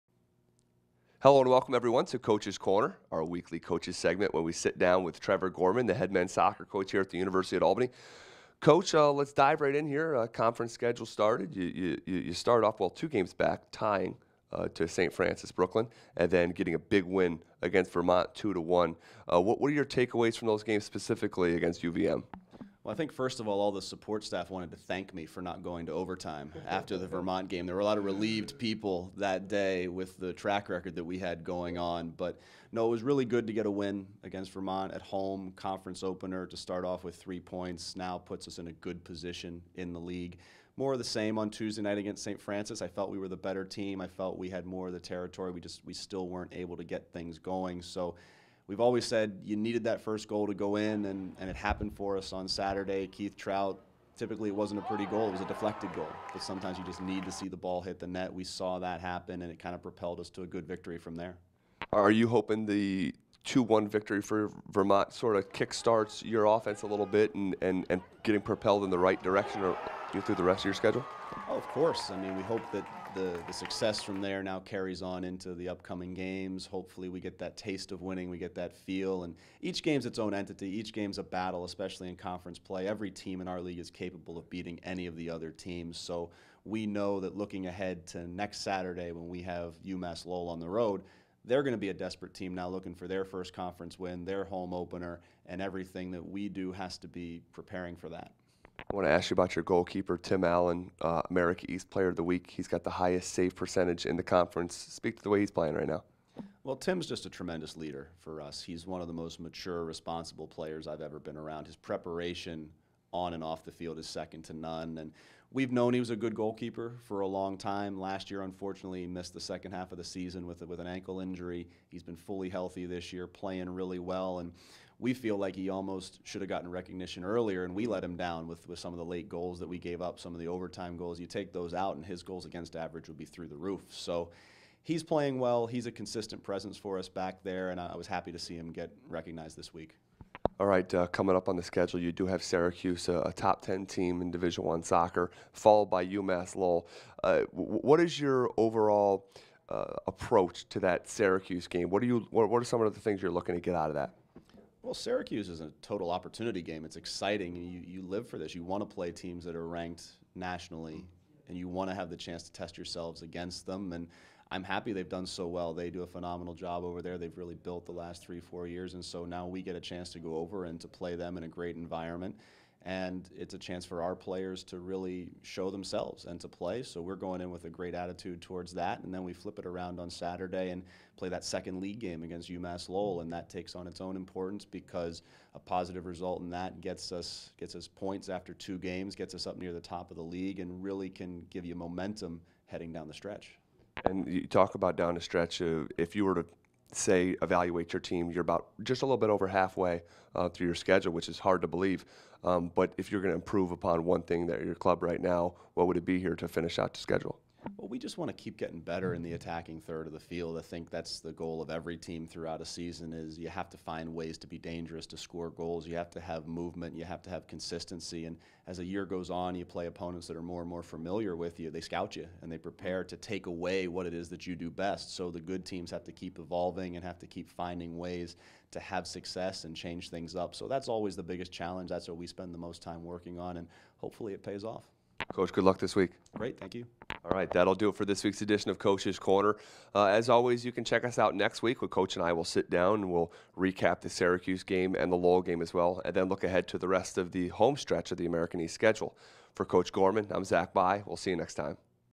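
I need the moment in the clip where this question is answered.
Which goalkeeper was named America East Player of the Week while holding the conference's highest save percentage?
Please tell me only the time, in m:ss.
1:40.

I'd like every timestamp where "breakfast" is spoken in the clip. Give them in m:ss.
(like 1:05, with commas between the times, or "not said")
not said.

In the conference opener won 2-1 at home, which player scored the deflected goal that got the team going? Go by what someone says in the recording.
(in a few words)
Keith Trout.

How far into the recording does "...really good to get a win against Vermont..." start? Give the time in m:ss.
0:33.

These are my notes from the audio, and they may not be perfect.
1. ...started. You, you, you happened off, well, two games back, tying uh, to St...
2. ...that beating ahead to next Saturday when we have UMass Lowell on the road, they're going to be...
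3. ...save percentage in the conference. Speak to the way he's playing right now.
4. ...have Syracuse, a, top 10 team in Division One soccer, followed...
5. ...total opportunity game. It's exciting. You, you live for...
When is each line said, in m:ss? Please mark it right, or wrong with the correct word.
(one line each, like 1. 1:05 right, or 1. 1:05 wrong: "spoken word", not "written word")
1. 0:11 wrong: "started", not "happened"
2. 1:27 wrong: "looking", not "beating"
3. 1:43 right
4. 2:22 right
5. 2:35 right.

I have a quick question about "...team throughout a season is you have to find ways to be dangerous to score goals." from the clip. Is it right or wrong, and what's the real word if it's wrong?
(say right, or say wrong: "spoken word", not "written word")
right.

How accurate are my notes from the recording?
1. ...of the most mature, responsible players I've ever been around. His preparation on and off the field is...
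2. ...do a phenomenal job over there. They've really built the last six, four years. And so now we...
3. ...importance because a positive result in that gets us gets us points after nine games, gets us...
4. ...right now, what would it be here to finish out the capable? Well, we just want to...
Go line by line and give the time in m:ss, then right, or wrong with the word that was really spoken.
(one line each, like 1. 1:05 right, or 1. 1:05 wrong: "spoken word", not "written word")
1. 1:49 right
2. 2:45 wrong: "three", not "six"
3. 3:04 wrong: "two", not "nine"
4. 3:25 wrong: "schedule", not "capable".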